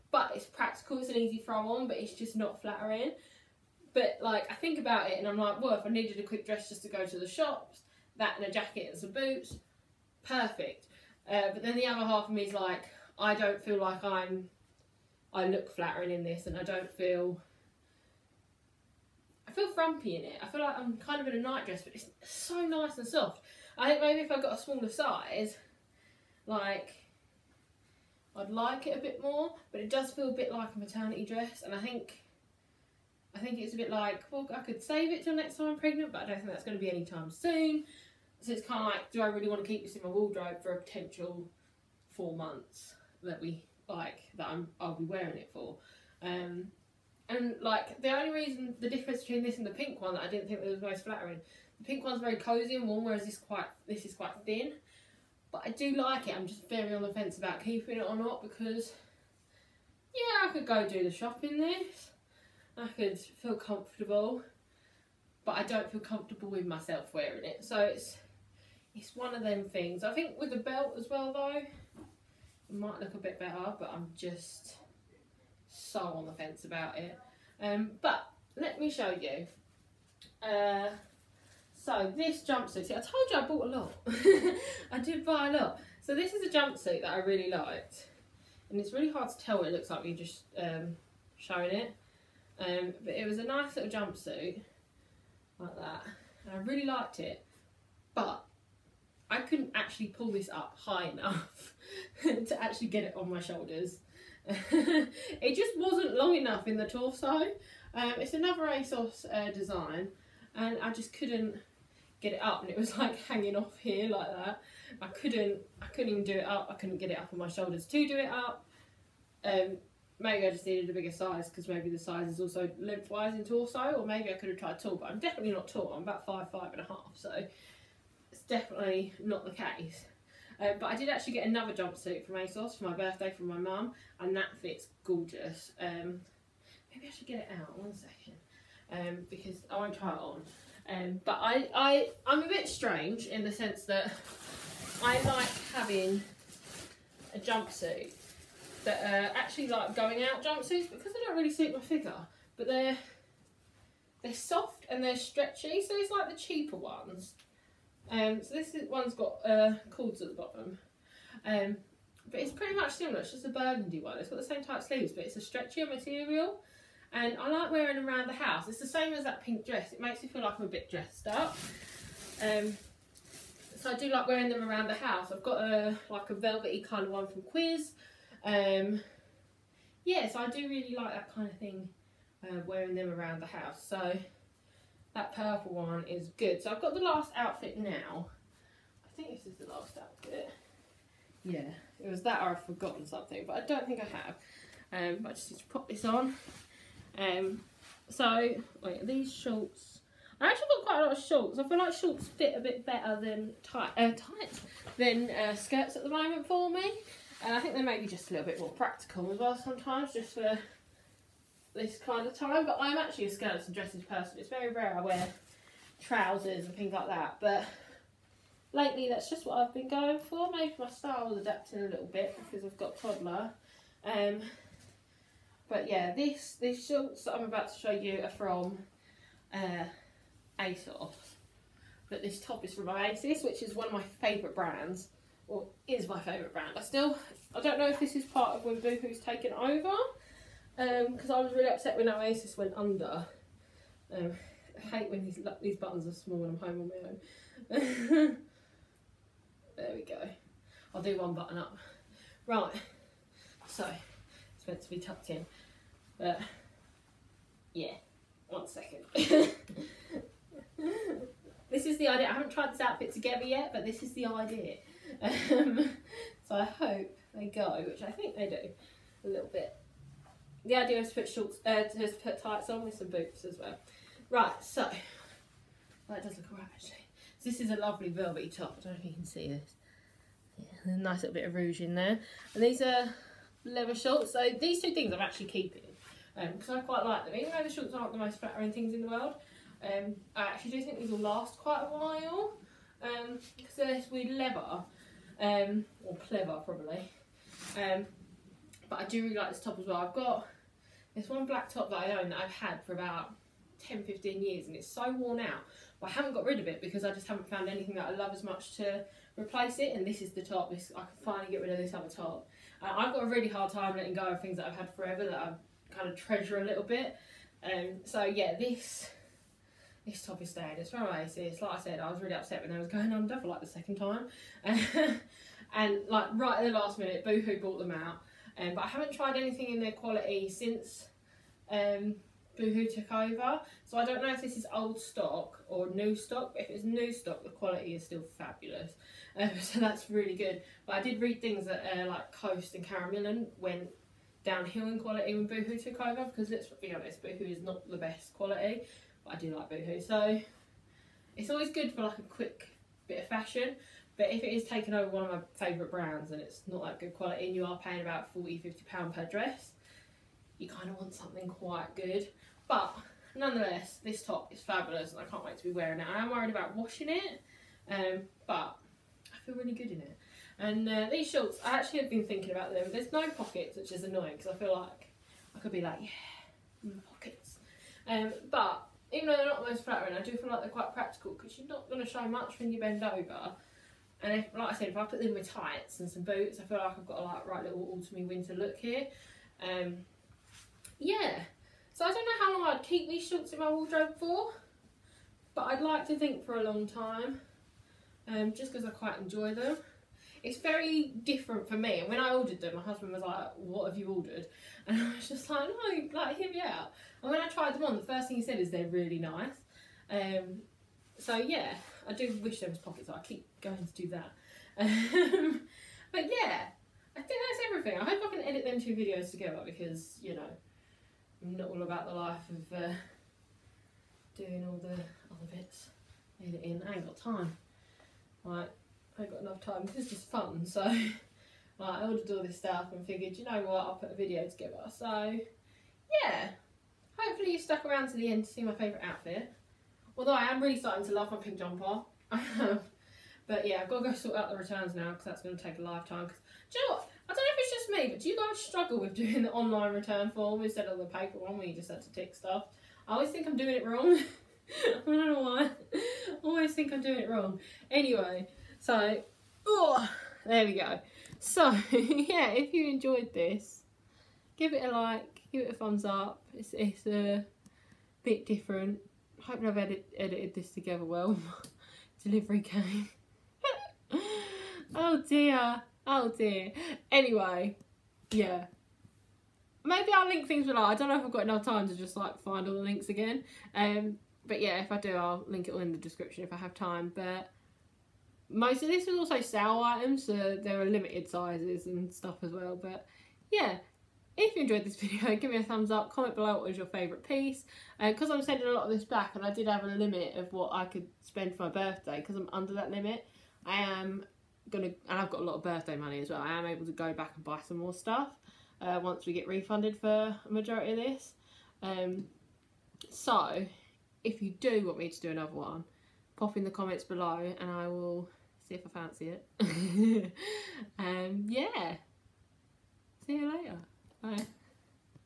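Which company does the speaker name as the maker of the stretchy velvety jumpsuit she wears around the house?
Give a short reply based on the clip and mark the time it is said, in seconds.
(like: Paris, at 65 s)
Quiz, at 177 s.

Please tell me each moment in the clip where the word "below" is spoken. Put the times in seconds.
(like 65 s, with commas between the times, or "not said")
480 s, 496 s, 517 s.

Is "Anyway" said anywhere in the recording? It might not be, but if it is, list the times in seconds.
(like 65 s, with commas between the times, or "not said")
457 s, 477 s.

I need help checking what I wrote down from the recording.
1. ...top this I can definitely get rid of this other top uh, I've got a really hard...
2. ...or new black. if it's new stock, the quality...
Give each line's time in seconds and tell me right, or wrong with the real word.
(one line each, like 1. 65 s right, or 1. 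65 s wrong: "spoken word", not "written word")
1. 310 s wrong: "finally", not "definitely"
2. 335 s wrong: "stock", not "black".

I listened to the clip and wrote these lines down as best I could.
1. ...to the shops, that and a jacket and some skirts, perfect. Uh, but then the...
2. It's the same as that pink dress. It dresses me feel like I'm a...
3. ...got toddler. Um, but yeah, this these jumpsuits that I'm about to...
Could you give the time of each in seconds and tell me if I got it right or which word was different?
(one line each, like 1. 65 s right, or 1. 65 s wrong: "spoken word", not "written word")
1. 7 s wrong: "boots", not "skirts"
2. 168 s wrong: "makes", not "dresses"
3. 222 s wrong: "shorts", not "jumpsuits".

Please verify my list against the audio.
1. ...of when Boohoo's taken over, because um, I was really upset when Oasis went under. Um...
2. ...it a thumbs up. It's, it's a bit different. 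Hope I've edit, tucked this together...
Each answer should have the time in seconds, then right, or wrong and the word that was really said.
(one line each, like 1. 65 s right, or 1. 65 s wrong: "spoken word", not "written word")
1. 238 s right
2. 465 s wrong: "edited", not "tucked".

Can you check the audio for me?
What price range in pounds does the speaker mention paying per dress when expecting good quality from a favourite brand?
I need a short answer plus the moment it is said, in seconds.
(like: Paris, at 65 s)
£40-50, at 358 s.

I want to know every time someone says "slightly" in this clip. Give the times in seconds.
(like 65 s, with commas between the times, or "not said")
not said.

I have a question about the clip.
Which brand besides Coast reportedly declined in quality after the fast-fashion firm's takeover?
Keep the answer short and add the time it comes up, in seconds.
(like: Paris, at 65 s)
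Karen Millen, at 342 s.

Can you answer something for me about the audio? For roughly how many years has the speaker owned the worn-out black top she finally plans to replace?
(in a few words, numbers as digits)
10-15 years.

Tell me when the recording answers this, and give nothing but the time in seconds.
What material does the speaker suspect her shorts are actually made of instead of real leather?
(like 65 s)
296 s.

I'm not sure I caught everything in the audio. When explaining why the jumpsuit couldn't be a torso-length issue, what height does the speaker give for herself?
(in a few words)
5 and a half.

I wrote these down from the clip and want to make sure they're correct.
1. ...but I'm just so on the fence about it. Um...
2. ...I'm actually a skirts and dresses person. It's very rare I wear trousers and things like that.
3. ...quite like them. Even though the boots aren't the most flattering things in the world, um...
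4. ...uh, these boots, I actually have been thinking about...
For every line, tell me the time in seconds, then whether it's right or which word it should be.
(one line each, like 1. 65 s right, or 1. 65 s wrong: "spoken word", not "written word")
1. 73 s right
2. 212 s right
3. 286 s wrong: "shorts", not "boots"
4. 370 s wrong: "shorts", not "boots".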